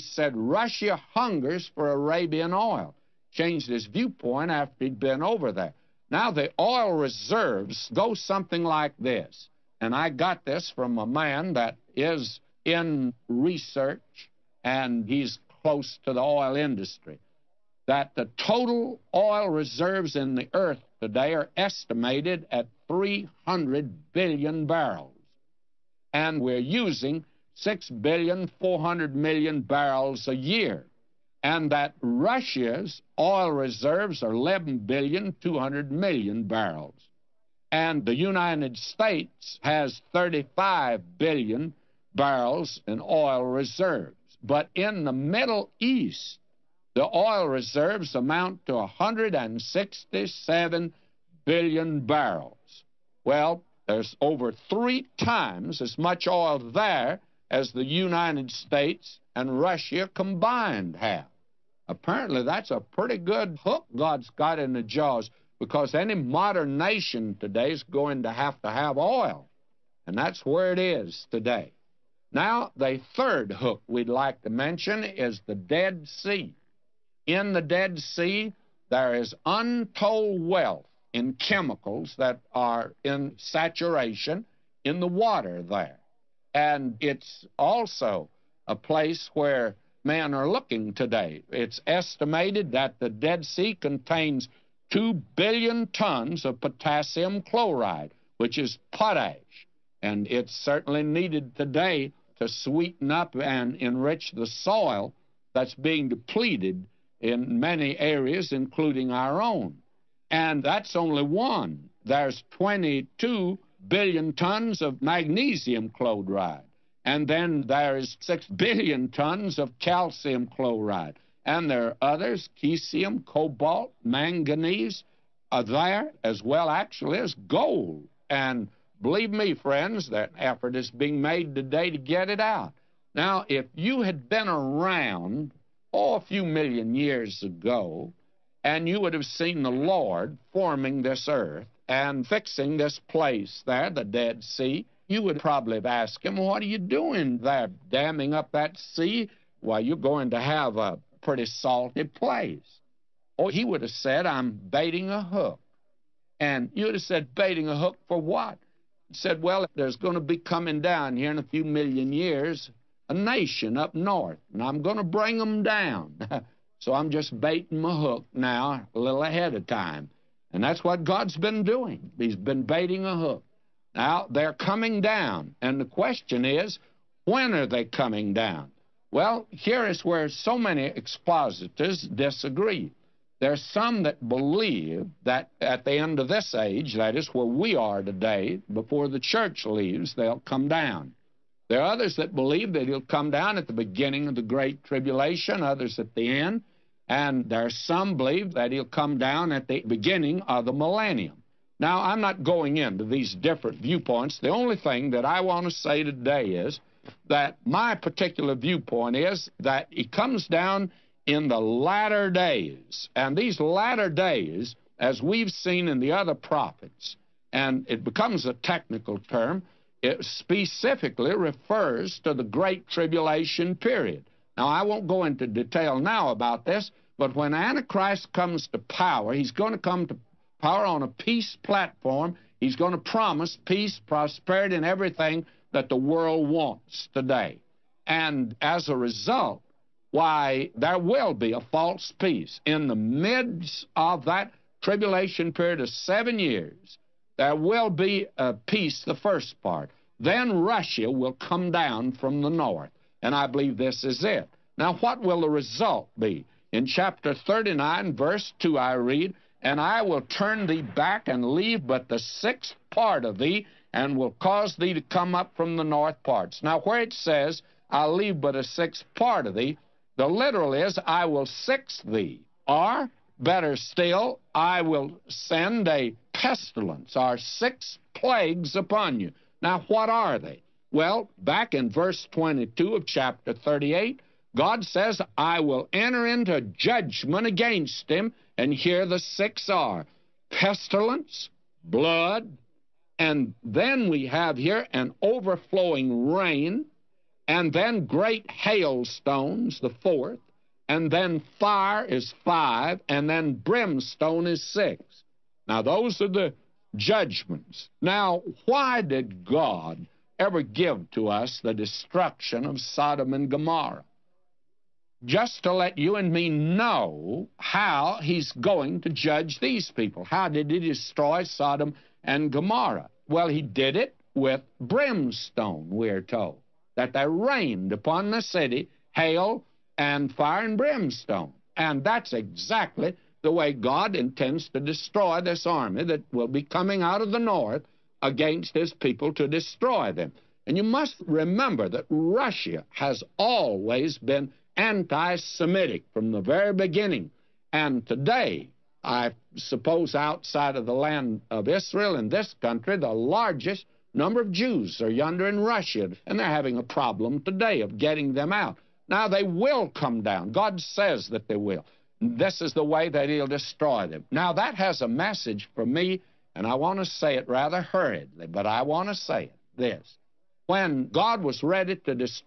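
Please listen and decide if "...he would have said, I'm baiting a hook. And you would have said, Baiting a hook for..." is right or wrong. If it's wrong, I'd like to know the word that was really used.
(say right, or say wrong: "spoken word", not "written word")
right.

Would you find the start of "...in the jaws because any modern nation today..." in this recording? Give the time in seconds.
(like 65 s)
64 s.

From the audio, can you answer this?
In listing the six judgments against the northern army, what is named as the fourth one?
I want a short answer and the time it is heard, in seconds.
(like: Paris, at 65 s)
great hailstones, at 298 s.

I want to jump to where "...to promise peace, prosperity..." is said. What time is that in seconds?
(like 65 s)
232 s.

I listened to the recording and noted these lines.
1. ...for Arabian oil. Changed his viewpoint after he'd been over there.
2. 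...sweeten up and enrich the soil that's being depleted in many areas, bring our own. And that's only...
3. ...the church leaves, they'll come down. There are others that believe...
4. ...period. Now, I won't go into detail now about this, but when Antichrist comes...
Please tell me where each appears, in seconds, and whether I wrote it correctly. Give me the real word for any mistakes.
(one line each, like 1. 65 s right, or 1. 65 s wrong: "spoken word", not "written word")
1. 1 s right
2. 102 s wrong: "including", not "bring"
3. 189 s right
4. 223 s right.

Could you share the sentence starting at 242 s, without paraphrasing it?
In the midst of that tribulation period of seven years, there will be a peace, the first part.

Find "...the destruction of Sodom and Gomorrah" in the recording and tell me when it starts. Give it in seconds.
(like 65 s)
311 s.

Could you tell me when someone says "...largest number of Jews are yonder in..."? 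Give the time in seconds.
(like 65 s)
353 s.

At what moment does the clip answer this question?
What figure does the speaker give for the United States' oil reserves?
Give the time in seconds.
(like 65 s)
40 s.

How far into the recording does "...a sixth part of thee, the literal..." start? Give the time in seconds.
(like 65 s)
268 s.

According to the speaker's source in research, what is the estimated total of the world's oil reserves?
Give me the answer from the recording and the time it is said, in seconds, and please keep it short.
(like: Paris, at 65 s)
300 billion barrels, at 22 s.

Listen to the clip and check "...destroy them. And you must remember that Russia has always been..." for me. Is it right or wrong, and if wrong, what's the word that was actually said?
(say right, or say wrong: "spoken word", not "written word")
right.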